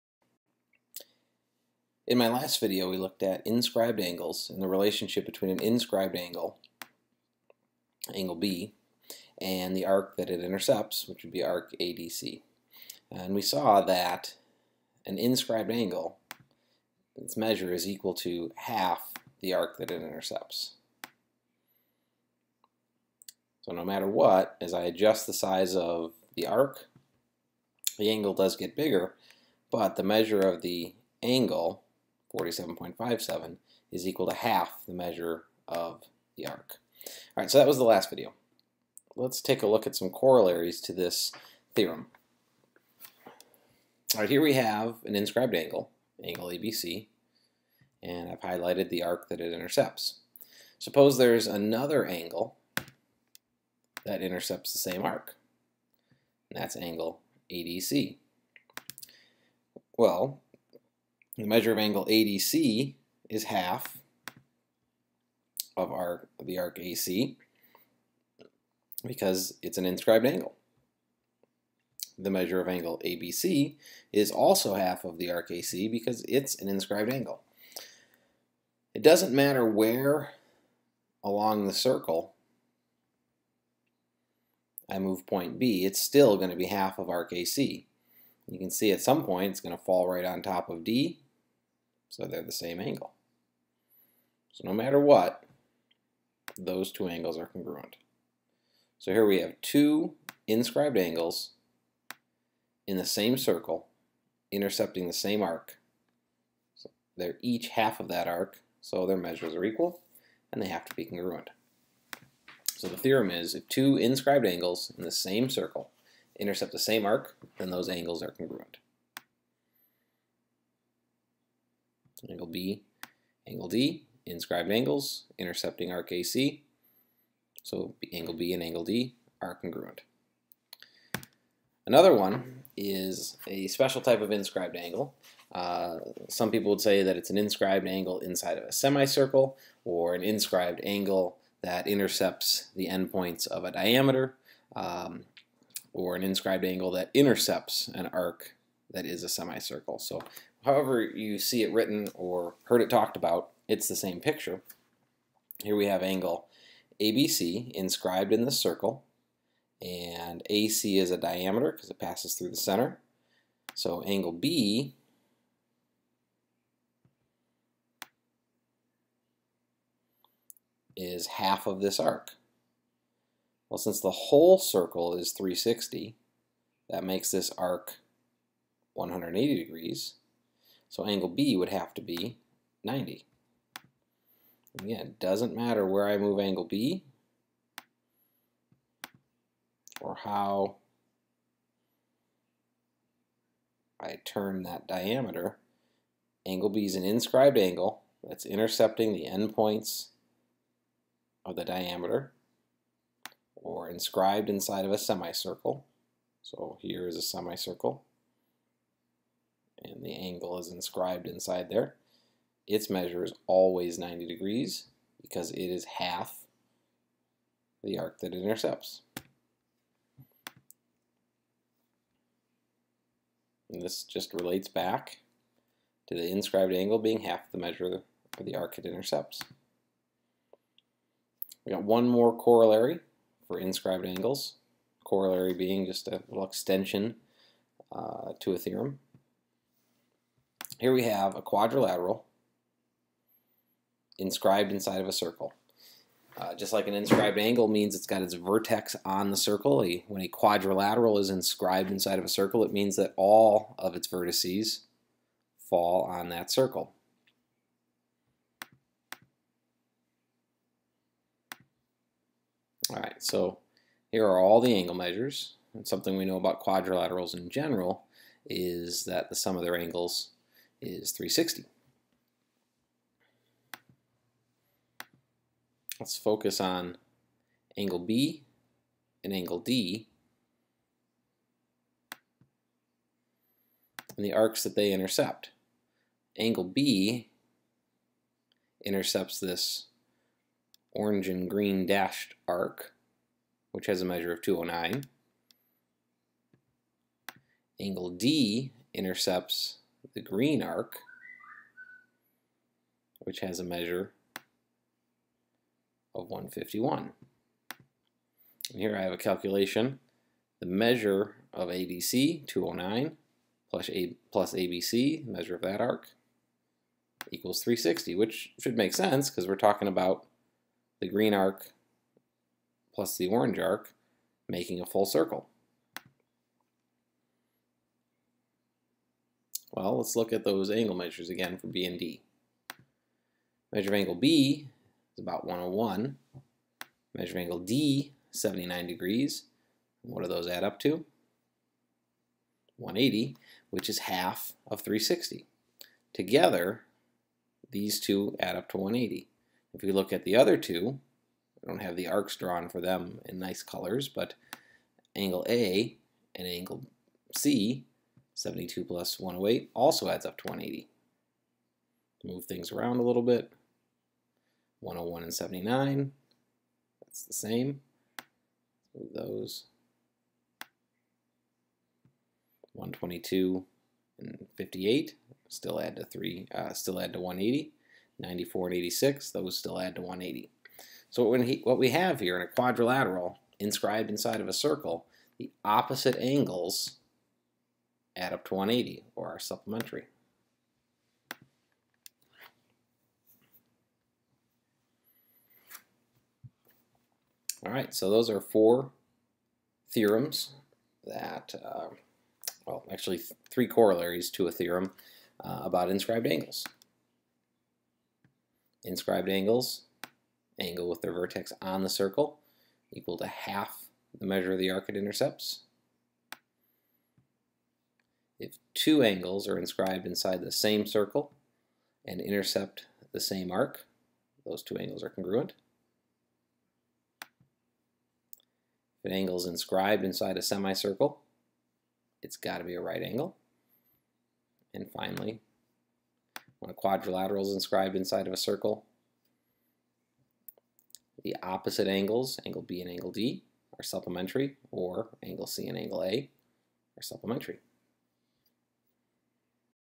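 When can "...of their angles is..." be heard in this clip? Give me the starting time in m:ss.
4:29.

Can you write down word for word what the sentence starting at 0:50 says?
Suppose there's another angle that intercepts the same arc, and that's angle ADC.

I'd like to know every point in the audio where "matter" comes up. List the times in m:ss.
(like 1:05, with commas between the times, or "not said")
0:23, 1:19, 1:34, 3:05.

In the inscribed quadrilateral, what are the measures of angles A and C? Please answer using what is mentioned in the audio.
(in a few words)
72 and 108.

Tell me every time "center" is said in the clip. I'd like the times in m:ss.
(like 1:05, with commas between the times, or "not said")
2:42.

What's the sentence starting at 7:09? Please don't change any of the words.
If an angle is inscribed inside a semicircle, it's got to be a right angle.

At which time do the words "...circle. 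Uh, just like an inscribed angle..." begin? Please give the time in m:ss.
4:05.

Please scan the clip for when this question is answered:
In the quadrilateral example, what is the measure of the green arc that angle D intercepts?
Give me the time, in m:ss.
5:06.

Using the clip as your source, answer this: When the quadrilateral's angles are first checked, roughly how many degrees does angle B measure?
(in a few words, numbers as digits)
101.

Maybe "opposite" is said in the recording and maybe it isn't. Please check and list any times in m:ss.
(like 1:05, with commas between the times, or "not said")
6:25, 7:21.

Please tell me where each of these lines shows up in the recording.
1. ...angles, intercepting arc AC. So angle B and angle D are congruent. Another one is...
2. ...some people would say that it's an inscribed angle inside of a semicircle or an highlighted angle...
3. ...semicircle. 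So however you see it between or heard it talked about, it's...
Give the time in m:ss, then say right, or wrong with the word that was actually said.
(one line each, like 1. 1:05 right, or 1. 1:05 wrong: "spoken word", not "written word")
1. 2:04 right
2. 2:16 wrong: "inscribed", not "highlighted"
3. 2:29 wrong: "written", not "between".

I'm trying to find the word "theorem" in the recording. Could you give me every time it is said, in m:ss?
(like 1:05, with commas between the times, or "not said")
0:41, 1:52, 3:58, 6:39, 6:44.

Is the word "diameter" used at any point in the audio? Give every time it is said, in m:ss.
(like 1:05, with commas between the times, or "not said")
2:23, 2:41, 3:14, 3:21.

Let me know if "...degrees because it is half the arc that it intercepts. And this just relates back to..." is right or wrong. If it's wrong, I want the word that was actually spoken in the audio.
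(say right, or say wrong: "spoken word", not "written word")
right.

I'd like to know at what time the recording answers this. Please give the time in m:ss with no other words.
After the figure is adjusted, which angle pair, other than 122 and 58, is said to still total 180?
6:18.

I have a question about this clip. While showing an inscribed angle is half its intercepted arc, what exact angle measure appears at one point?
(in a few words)
47.57.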